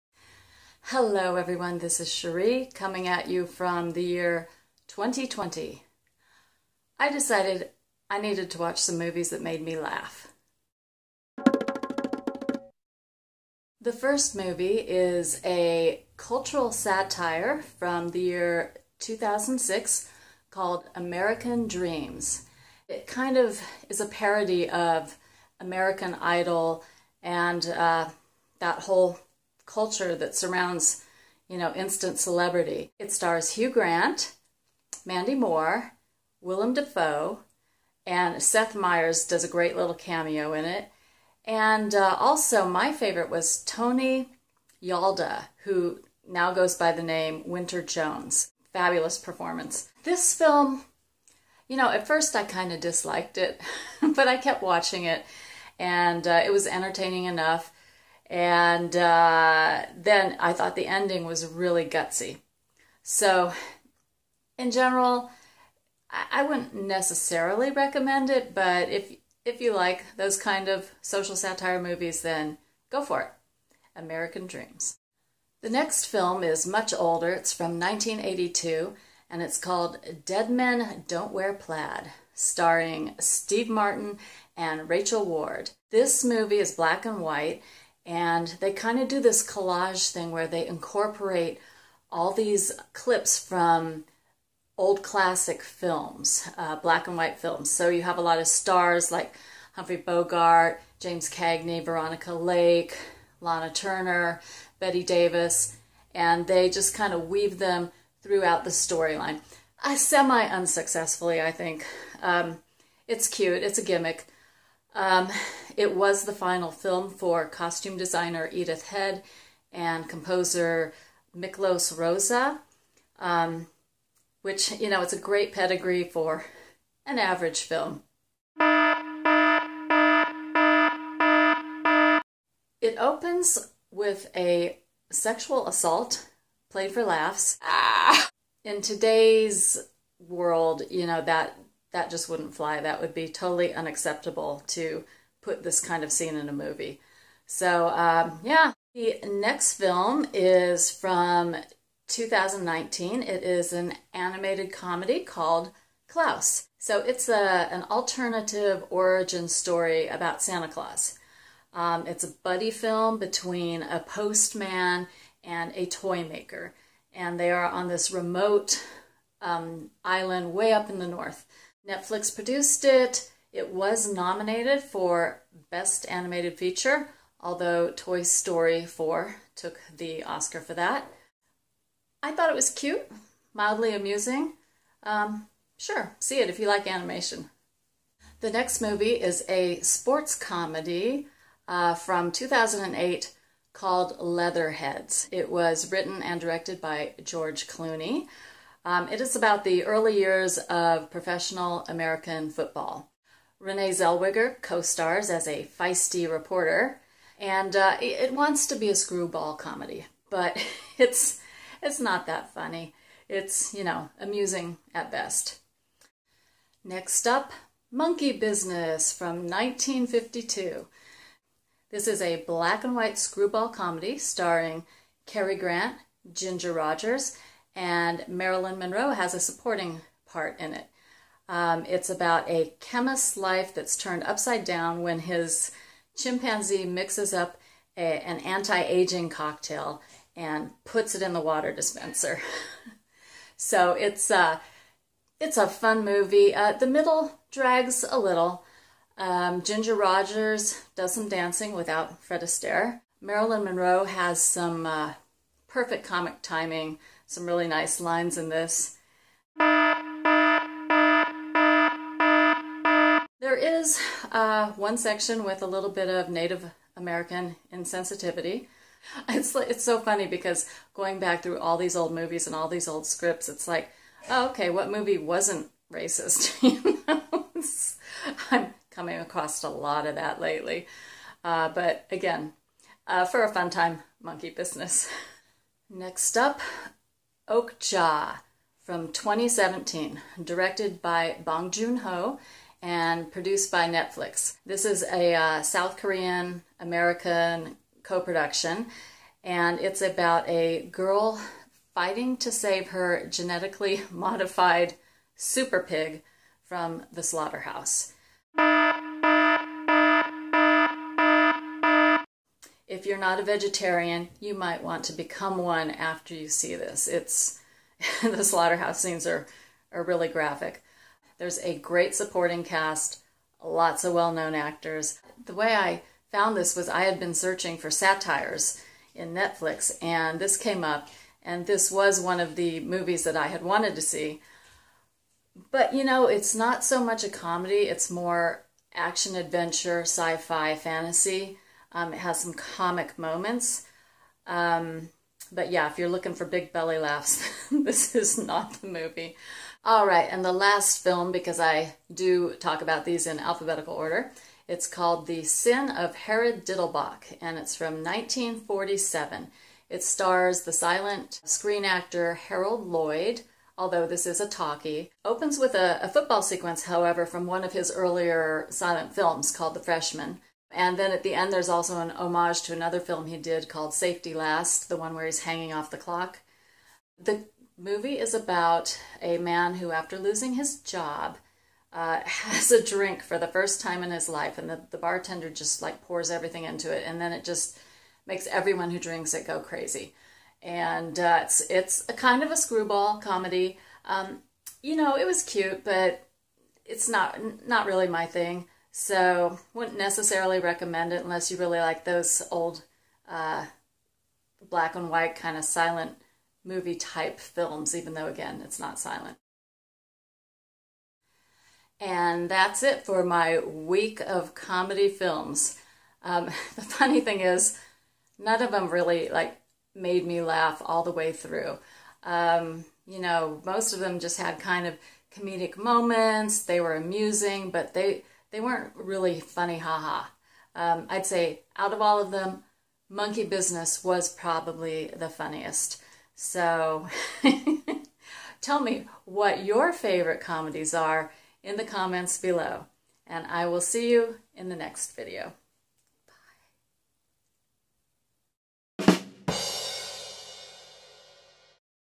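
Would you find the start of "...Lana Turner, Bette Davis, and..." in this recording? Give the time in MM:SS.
01:43.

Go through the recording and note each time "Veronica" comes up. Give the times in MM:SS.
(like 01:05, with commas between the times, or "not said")
01:41.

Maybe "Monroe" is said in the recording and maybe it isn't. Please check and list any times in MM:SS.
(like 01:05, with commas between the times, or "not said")
03:48, 04:13.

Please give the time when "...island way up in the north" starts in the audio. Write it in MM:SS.
02:50.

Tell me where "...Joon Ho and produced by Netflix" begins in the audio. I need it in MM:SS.
04:51.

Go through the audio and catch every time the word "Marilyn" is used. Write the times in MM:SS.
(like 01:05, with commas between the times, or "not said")
03:48, 04:13.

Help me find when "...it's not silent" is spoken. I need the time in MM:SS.
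06:48.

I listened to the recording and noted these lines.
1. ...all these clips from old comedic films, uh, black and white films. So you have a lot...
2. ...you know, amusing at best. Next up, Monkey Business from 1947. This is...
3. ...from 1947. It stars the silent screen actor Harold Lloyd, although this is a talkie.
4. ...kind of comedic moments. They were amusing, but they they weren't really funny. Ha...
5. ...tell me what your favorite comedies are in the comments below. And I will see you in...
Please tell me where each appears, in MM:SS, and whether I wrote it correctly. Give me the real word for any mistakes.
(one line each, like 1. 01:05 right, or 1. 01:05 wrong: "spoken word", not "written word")
1. 01:32 wrong: "classic", not "comedic"
2. 03:33 wrong: "1952", not "1947"
3. 05:57 right
4. 07:04 right
5. 07:18 right.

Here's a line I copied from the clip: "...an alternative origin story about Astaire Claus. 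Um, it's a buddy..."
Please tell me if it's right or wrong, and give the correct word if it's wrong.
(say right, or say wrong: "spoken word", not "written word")
wrong: "Santa", not "Astaire".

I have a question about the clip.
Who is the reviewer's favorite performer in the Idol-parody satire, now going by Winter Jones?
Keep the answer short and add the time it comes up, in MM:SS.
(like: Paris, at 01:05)
Tony Yalda, at 00:43.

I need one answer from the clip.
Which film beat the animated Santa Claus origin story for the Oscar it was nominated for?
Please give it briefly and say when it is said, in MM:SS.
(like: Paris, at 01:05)
Toy Story 4, at 02:57.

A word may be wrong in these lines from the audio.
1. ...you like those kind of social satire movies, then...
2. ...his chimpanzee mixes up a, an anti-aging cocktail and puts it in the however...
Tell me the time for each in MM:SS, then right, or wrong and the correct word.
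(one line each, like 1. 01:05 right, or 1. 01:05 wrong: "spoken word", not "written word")
1. 01:09 right
2. 03:55 wrong: "water", not "however".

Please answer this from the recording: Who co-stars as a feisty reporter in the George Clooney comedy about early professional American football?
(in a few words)
Renee Zellweger.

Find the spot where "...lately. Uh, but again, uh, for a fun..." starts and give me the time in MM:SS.
04:40.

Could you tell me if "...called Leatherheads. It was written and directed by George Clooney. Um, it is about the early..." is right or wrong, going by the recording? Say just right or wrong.
right.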